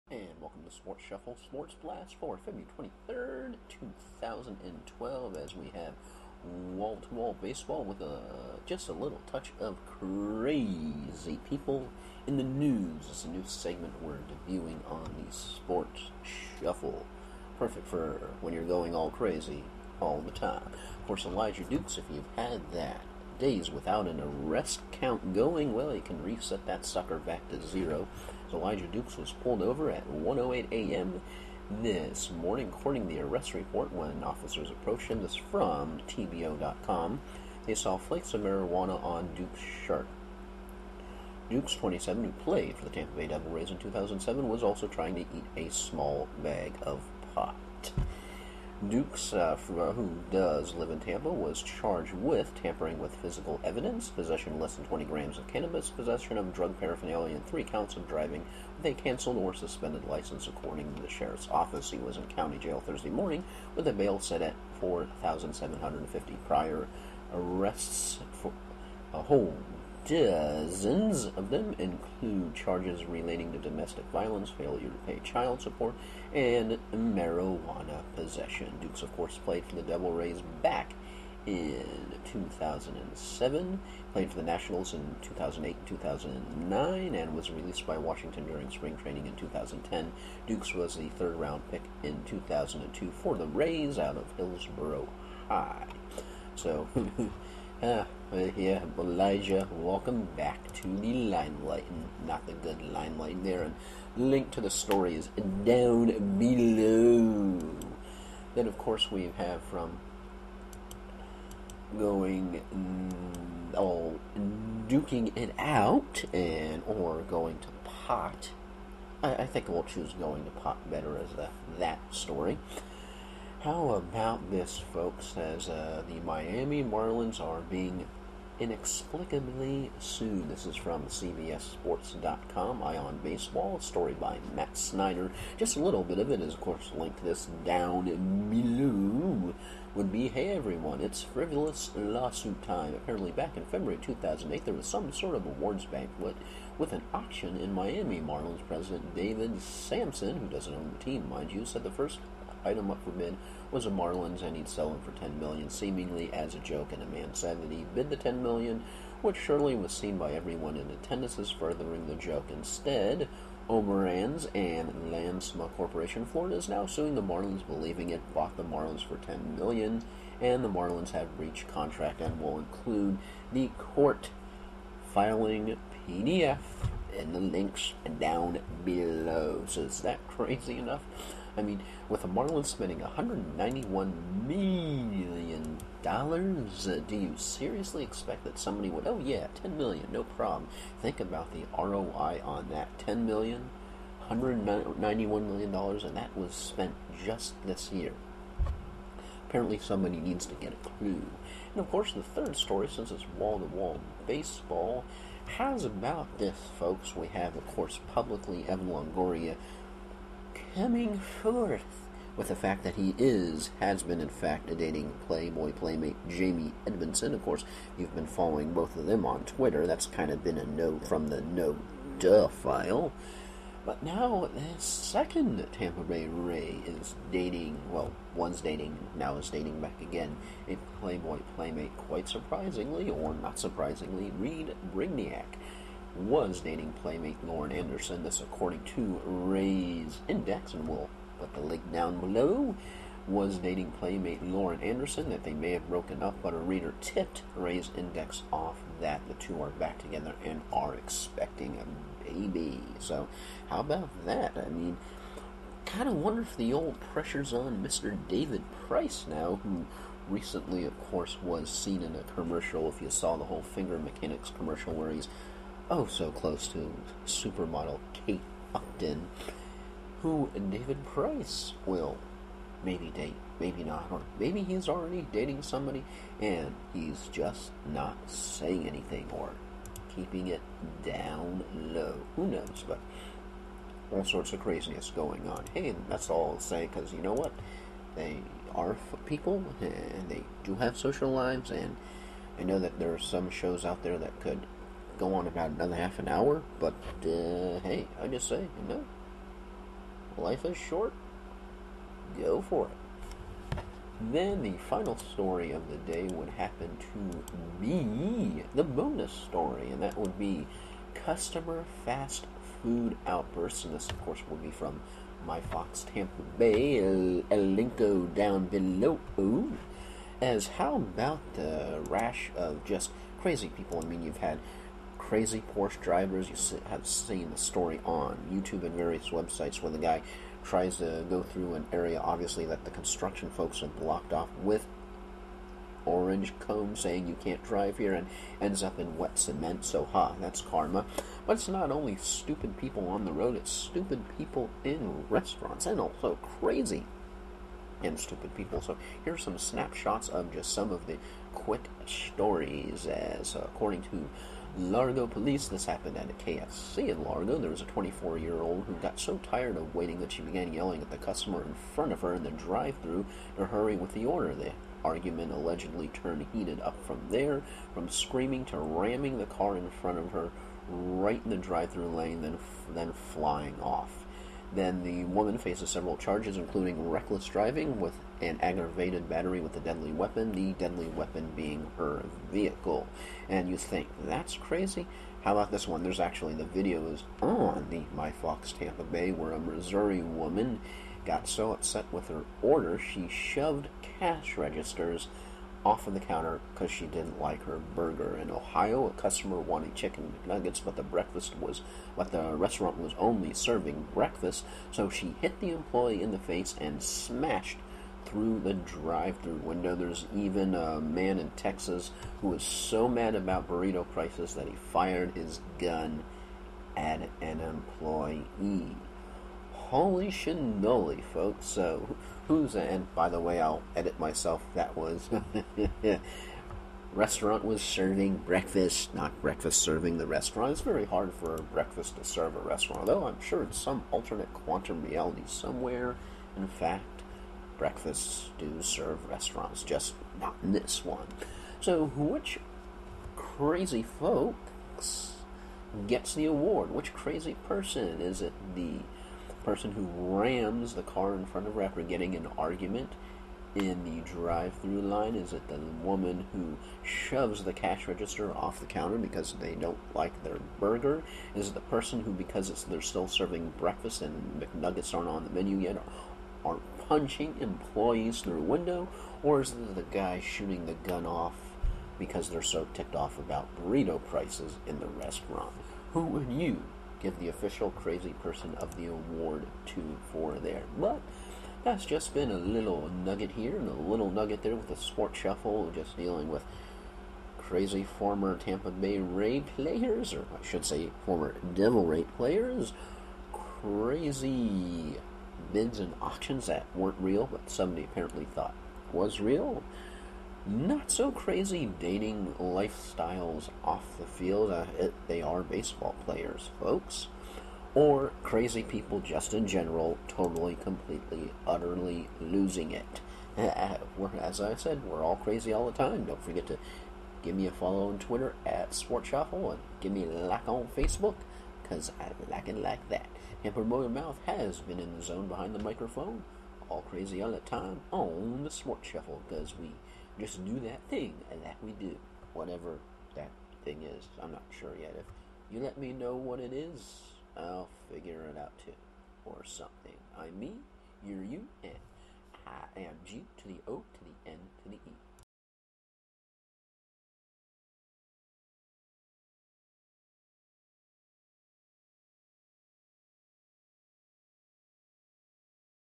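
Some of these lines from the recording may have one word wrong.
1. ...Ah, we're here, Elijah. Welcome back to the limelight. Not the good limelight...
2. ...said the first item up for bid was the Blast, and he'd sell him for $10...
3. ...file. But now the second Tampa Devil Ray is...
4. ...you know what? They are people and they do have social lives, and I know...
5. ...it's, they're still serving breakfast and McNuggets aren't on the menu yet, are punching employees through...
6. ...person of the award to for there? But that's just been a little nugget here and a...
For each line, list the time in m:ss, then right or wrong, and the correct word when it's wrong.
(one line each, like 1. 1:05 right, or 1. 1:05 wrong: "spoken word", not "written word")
1. 1:37 right
2. 2:31 wrong: "Marlins", not "Blast"
3. 3:42 wrong: "Bay", not "Devil"
4. 4:47 right
5. 7:42 right
6. 7:58 right.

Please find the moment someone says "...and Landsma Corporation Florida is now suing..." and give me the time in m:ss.
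2:44.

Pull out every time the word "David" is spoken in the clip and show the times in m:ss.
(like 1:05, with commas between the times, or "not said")
2:29, 4:18, 4:30.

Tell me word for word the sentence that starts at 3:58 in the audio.
This, according to Rays Index, and we'll put the link down below.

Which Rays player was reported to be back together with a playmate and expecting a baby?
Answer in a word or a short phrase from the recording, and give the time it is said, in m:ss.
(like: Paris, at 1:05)
Reid Brignac, at 3:54.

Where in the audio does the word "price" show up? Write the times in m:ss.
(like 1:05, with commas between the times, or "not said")
4:18, 4:31, 6:54, 7:54.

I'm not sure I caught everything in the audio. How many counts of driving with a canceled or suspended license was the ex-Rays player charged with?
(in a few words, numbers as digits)
3.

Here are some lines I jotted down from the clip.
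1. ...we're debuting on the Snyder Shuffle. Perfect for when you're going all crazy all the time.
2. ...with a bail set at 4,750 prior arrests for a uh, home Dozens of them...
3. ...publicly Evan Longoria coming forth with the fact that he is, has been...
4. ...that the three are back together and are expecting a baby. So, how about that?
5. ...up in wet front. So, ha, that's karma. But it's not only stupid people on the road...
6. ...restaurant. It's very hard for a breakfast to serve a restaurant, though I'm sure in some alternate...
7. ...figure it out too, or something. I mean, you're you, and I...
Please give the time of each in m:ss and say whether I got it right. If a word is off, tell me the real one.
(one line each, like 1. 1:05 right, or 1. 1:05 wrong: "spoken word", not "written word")
1. 0:14 wrong: "Sports", not "Snyder"
2. 1:03 right
3. 3:28 right
4. 4:08 wrong: "two", not "three"
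5. 5:38 wrong: "cement", not "front"
6. 7:10 right
7. 8:58 right.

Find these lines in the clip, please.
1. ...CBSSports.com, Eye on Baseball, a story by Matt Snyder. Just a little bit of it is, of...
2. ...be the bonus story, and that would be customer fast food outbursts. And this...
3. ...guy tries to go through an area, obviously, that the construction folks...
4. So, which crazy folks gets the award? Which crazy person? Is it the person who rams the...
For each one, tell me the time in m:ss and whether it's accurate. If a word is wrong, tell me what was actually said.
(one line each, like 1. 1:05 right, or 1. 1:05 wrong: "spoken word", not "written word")
1. 2:11 right
2. 5:07 right
3. 5:29 right
4. 7:21 right.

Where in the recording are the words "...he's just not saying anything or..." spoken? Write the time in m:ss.
4:36.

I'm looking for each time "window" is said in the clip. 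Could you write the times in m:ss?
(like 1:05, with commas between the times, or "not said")
6:49, 7:48.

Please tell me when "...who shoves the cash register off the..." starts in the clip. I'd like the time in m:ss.
7:36.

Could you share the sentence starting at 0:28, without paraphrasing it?
Elijah Dukes was pulled over at 1:08 a.m.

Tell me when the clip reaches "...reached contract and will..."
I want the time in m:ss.
2:51.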